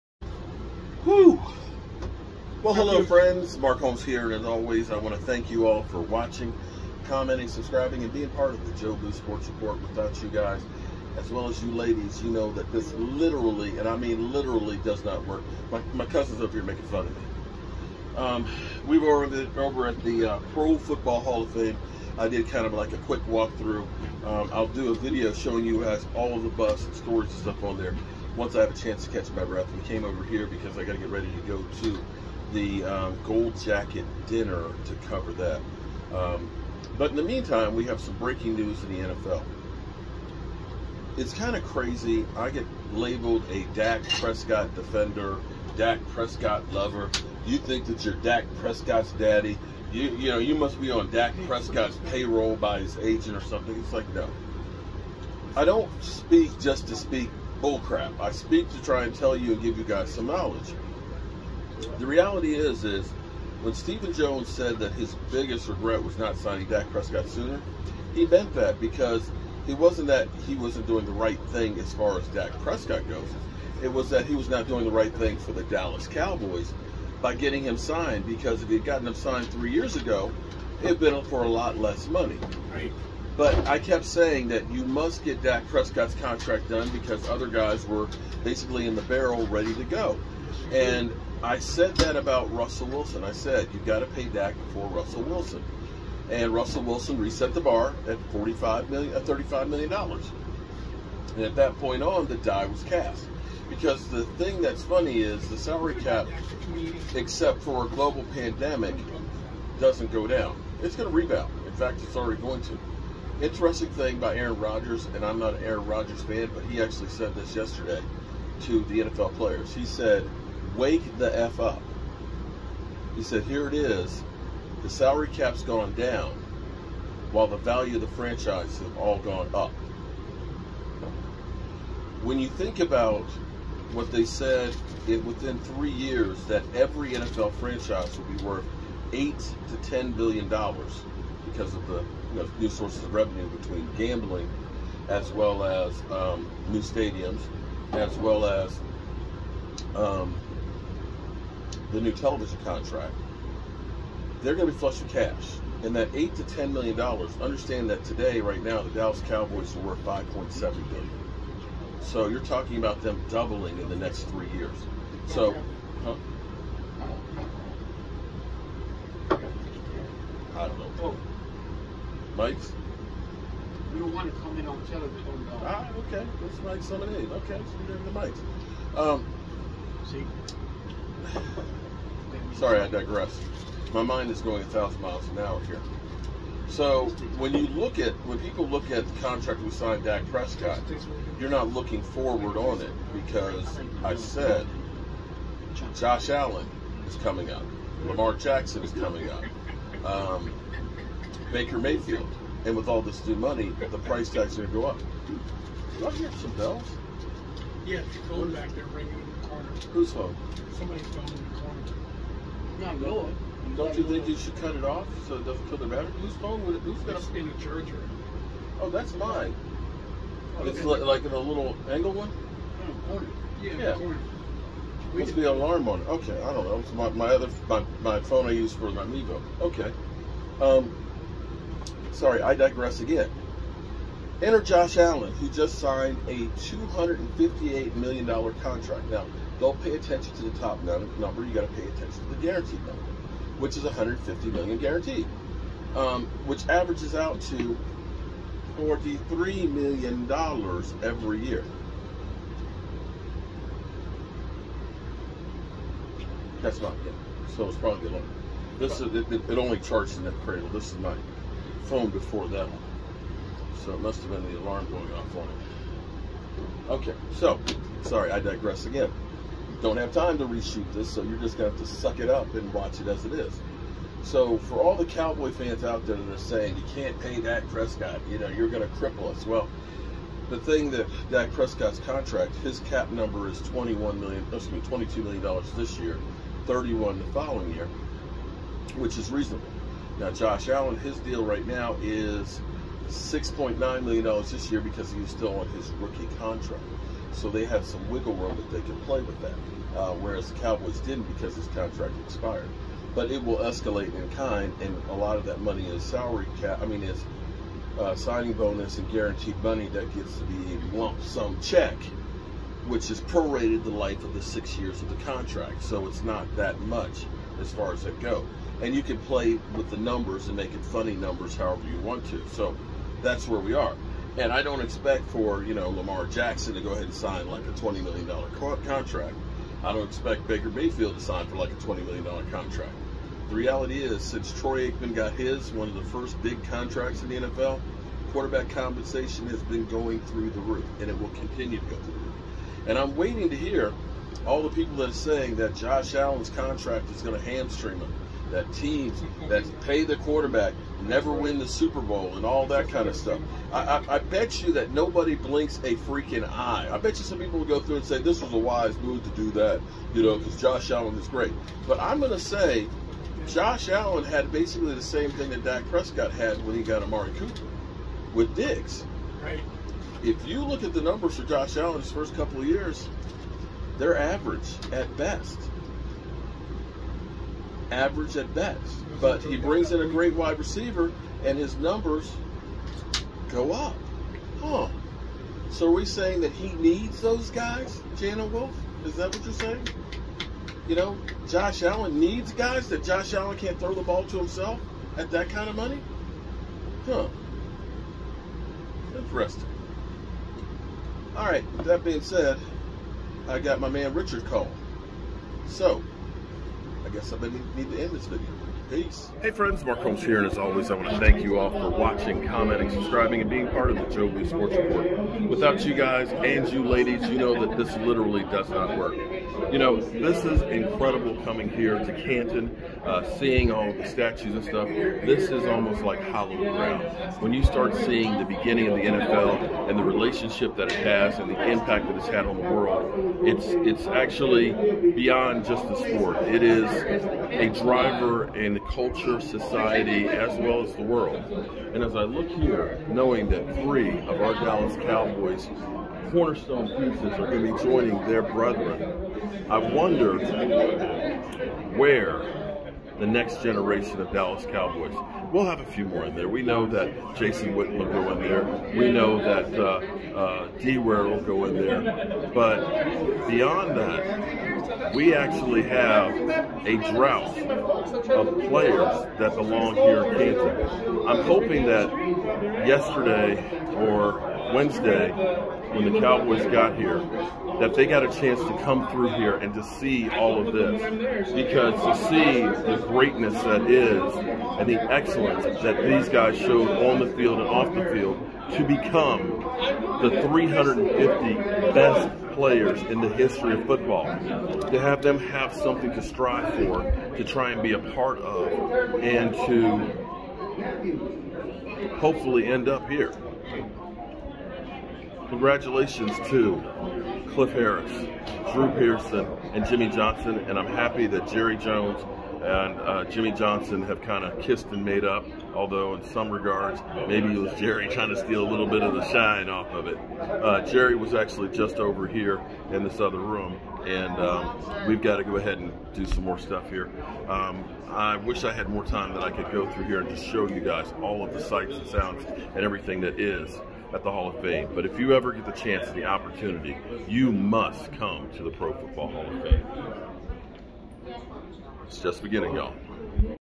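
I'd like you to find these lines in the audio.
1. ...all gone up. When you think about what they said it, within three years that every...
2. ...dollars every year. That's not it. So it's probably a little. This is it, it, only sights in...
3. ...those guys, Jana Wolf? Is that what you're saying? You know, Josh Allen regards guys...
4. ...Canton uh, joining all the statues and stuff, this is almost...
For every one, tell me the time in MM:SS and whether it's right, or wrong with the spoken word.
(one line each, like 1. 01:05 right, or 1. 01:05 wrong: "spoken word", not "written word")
1. 02:08 right
2. 04:10 wrong: "charts", not "sights"
3. 06:27 wrong: "needs", not "regards"
4. 07:02 wrong: "seeing", not "joining".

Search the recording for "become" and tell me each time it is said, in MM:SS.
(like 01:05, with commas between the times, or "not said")
08:08.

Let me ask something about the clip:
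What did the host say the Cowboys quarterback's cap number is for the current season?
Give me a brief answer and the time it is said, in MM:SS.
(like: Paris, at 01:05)
22 million dollars, at 04:44.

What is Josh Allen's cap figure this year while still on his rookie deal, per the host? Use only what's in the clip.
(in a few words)
$6.9 million.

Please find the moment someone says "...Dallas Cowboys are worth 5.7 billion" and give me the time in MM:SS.
02:38.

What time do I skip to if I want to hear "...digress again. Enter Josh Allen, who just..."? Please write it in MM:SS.
03:52.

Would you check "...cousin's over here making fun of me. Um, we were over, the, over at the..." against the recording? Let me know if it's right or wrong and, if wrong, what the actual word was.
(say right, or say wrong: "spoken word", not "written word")
right.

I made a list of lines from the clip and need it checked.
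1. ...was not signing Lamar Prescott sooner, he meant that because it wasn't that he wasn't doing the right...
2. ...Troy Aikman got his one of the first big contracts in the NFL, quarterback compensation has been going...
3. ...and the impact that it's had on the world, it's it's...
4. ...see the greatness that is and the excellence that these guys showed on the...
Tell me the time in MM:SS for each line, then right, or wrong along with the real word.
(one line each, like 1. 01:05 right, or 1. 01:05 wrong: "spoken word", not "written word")
1. 01:06 wrong: "Dak", not "Lamar"
2. 05:34 right
3. 07:11 right
4. 08:02 right.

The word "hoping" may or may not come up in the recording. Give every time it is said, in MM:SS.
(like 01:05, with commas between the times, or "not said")
07:51.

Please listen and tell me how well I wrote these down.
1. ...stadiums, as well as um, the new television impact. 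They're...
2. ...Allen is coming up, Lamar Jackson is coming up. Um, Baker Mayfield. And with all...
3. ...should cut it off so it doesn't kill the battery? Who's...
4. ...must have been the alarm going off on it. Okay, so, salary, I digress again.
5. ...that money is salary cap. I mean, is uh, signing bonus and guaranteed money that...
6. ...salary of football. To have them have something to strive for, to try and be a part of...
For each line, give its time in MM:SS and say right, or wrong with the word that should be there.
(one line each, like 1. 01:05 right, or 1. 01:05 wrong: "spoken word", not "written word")
1. 02:26 wrong: "contract", not "impact"
2. 03:16 right
3. 03:34 right
4. 04:24 wrong: "sorry", not "salary"
5. 05:05 right
6. 08:13 wrong: "history", not "salary".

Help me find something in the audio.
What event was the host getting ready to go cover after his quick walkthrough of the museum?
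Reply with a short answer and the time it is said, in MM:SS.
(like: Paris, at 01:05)
Gold Jacket dinner, at 00:33.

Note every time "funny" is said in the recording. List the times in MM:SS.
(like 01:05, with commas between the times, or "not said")
01:44, 05:20.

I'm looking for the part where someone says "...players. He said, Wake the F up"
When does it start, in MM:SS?
01:59.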